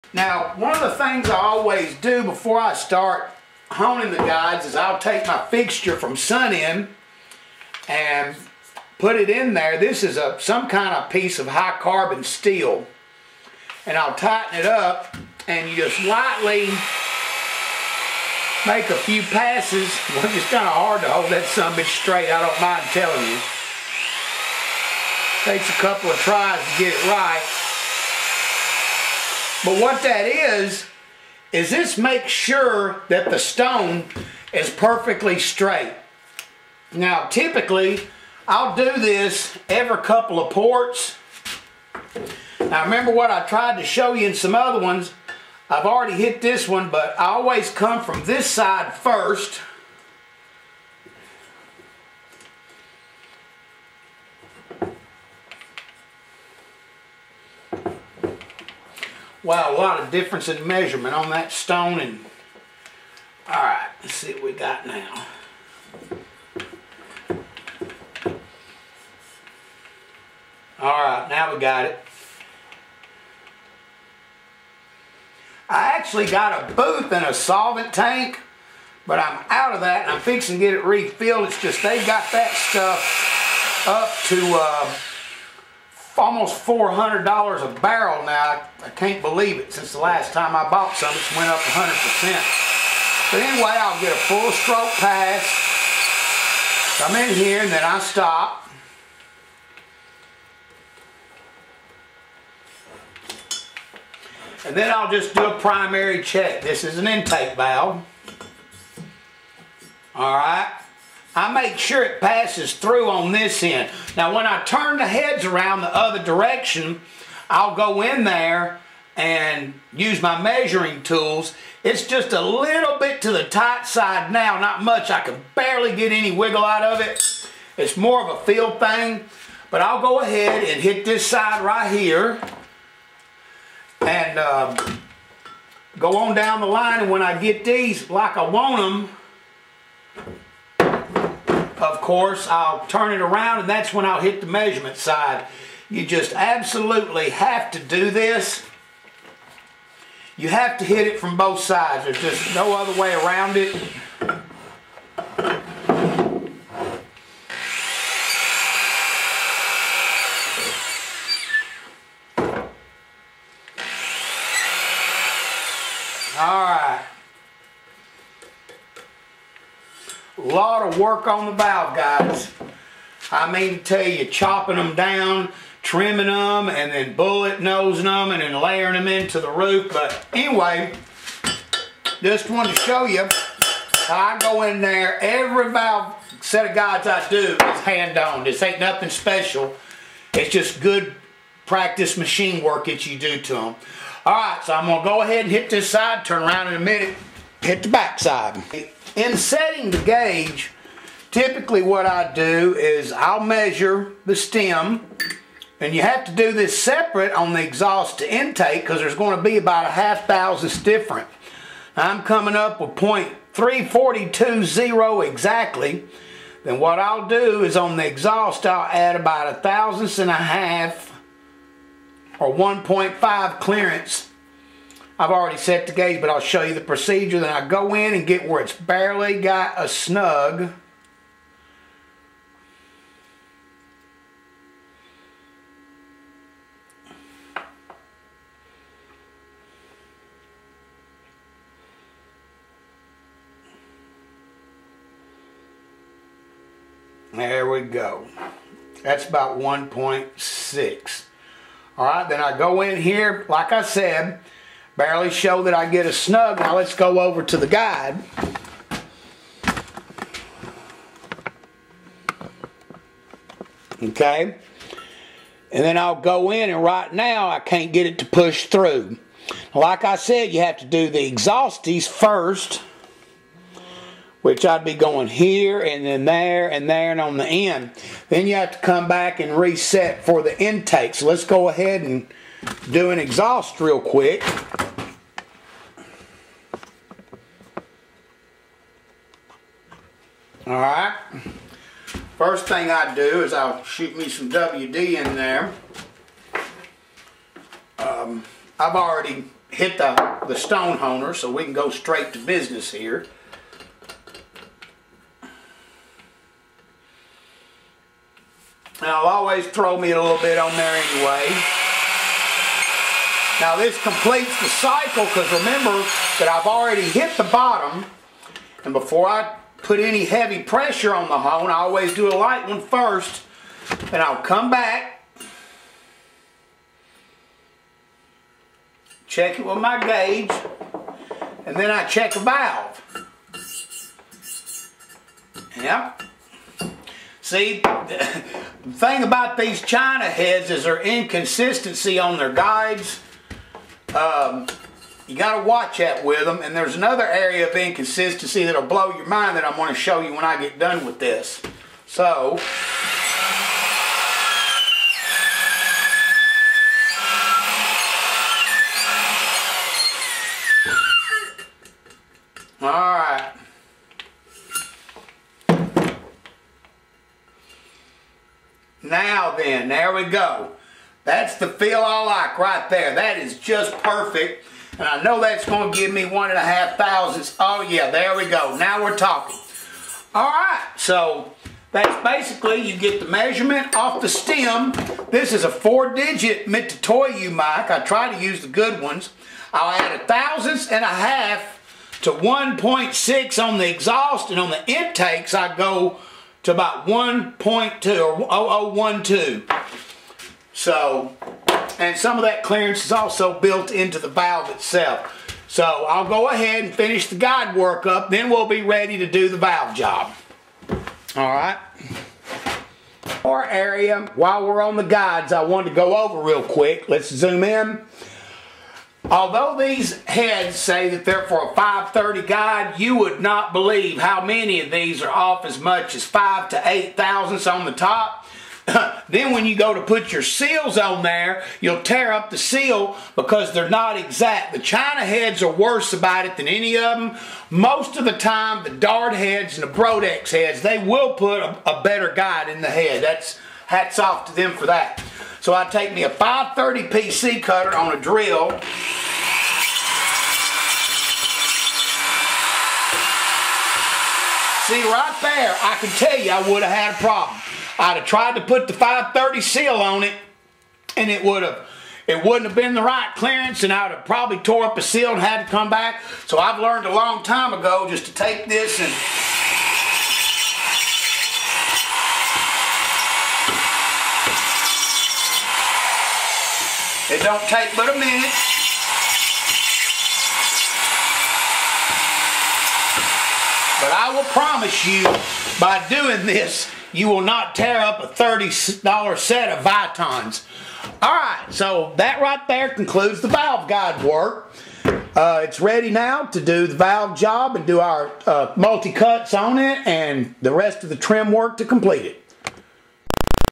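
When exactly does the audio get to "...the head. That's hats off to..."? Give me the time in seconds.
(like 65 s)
442 s.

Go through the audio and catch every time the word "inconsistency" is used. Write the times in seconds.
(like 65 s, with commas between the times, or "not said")
341 s, 347 s.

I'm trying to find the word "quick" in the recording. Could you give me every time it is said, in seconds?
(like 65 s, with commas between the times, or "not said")
284 s, 416 s.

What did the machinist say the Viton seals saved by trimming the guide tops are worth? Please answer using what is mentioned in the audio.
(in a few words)
$30.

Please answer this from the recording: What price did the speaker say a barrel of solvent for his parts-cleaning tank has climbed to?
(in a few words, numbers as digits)
almost $400.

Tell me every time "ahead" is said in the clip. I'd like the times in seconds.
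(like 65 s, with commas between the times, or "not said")
130 s, 195 s, 281 s, 406 s.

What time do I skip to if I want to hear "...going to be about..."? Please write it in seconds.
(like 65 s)
209 s.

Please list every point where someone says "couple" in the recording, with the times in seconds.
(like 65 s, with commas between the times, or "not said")
25 s, 40 s.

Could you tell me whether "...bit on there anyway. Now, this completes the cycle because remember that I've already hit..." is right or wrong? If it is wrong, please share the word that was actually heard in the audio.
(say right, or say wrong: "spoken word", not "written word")
right.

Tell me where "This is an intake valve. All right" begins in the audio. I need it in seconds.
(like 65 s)
106 s.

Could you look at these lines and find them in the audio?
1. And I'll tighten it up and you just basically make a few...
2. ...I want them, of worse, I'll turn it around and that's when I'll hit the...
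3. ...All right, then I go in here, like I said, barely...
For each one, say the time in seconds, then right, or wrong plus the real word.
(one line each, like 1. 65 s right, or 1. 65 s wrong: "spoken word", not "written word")
1. 13 s wrong: "lightly", not "basically"
2. 138 s wrong: "course", not "worse"
3. 251 s right.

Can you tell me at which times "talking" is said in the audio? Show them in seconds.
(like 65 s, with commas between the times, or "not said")
379 s.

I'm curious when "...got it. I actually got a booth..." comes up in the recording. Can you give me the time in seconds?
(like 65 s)
71 s.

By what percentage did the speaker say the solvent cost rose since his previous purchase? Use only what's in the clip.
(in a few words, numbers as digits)
100%.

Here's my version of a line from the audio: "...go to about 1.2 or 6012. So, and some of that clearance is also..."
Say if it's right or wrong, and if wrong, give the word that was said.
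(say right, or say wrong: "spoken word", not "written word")
wrong: "0012", not "6012".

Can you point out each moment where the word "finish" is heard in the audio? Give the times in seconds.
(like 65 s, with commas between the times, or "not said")
406 s.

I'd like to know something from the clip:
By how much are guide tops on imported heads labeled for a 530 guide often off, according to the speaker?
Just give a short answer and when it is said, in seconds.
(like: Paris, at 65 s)
5 to 8 thousandths, at 426 s.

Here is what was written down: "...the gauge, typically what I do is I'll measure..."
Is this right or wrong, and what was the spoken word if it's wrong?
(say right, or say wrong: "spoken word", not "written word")
right.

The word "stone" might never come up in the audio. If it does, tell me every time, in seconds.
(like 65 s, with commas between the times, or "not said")
33 s, 61 s, 300 s.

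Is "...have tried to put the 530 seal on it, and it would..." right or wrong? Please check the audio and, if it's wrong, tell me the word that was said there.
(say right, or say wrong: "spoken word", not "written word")
right.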